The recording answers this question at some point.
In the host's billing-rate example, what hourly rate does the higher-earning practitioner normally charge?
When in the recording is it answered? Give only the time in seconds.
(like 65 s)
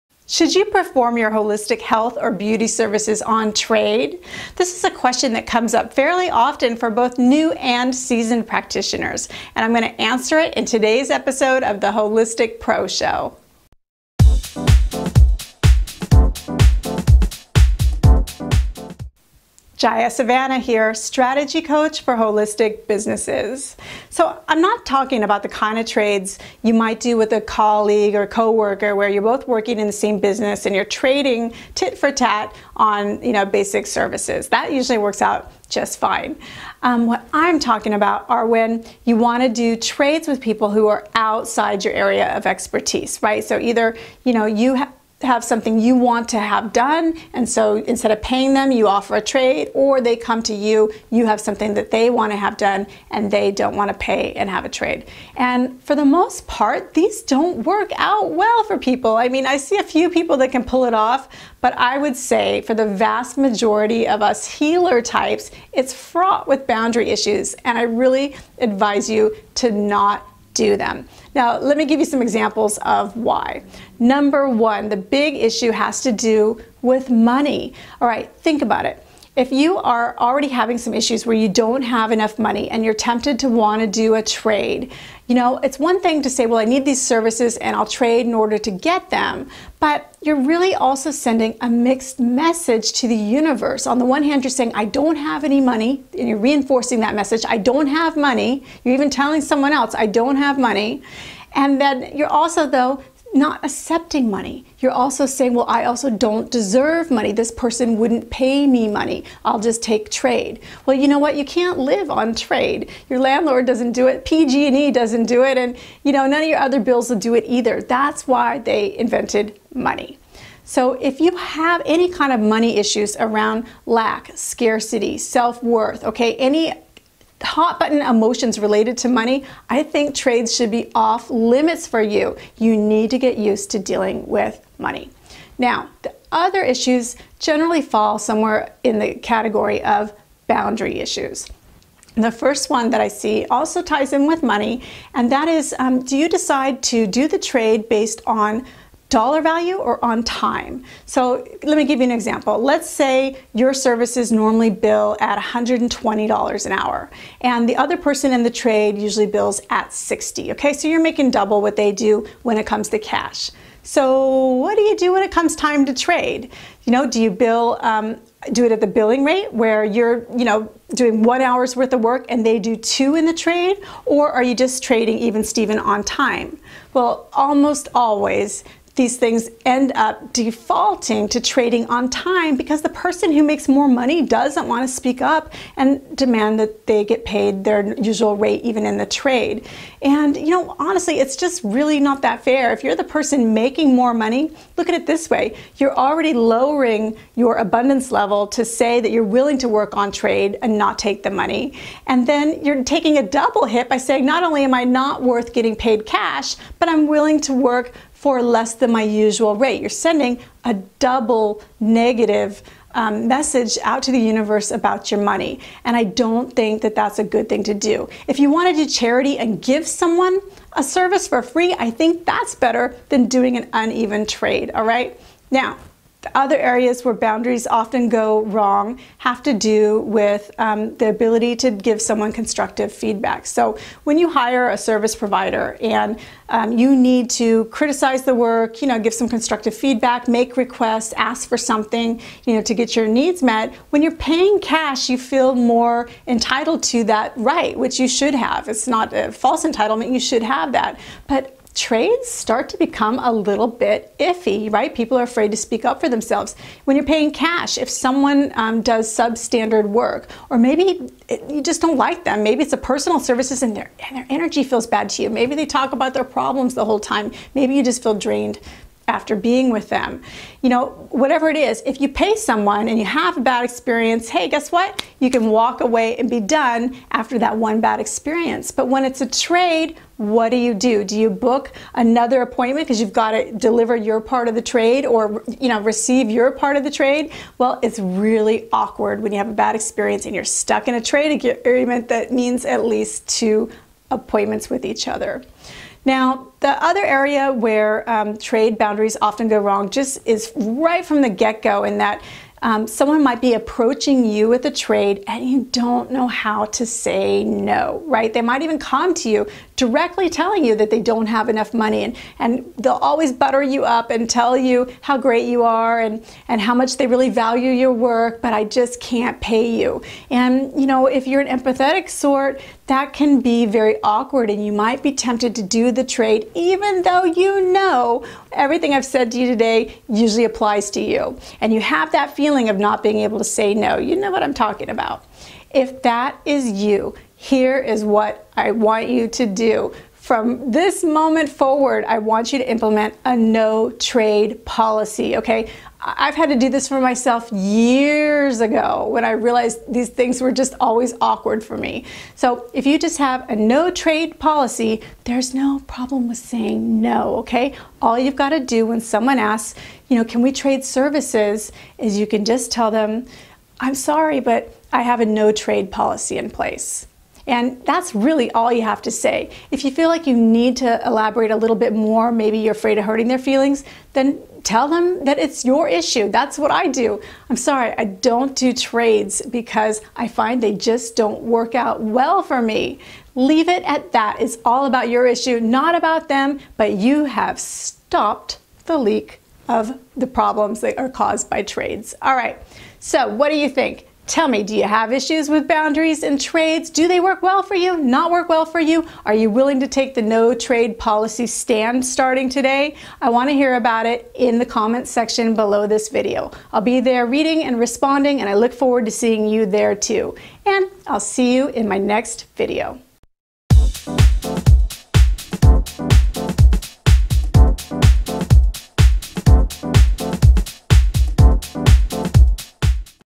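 155 s.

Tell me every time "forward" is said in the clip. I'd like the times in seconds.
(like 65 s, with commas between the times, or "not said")
341 s, 408 s.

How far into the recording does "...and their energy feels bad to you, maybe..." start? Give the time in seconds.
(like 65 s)
264 s.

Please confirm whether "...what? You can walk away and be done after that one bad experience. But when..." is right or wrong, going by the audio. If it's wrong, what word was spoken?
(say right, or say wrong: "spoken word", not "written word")
right.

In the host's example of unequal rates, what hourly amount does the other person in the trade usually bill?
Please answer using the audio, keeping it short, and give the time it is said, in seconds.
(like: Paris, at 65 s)
60, at 159 s.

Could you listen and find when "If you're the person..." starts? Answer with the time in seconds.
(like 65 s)
192 s.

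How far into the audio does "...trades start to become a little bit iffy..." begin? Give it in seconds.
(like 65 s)
251 s.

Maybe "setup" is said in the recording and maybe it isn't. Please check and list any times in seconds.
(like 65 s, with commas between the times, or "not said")
not said.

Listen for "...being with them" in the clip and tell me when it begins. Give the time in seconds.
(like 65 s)
269 s.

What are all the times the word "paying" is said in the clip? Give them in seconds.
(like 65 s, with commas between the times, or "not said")
48 s, 244 s, 257 s.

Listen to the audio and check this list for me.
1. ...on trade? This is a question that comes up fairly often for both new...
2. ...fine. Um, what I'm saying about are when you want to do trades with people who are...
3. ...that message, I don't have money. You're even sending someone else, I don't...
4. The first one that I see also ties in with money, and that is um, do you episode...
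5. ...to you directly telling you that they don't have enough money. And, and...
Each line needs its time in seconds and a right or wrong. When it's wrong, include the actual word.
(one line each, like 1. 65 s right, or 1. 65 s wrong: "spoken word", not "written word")
1. 3 s right
2. 35 s wrong: "talking", not "saying"
3. 96 s wrong: "telling", not "sending"
4. 142 s wrong: "decide", not "episode"
5. 309 s right.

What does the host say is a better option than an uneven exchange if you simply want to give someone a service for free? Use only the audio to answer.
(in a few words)
charity.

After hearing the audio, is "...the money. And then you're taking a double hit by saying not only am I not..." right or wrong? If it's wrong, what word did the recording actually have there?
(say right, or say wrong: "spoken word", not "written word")
right.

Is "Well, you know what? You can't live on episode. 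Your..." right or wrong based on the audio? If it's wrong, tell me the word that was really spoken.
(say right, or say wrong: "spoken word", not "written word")
wrong: "trade", not "episode".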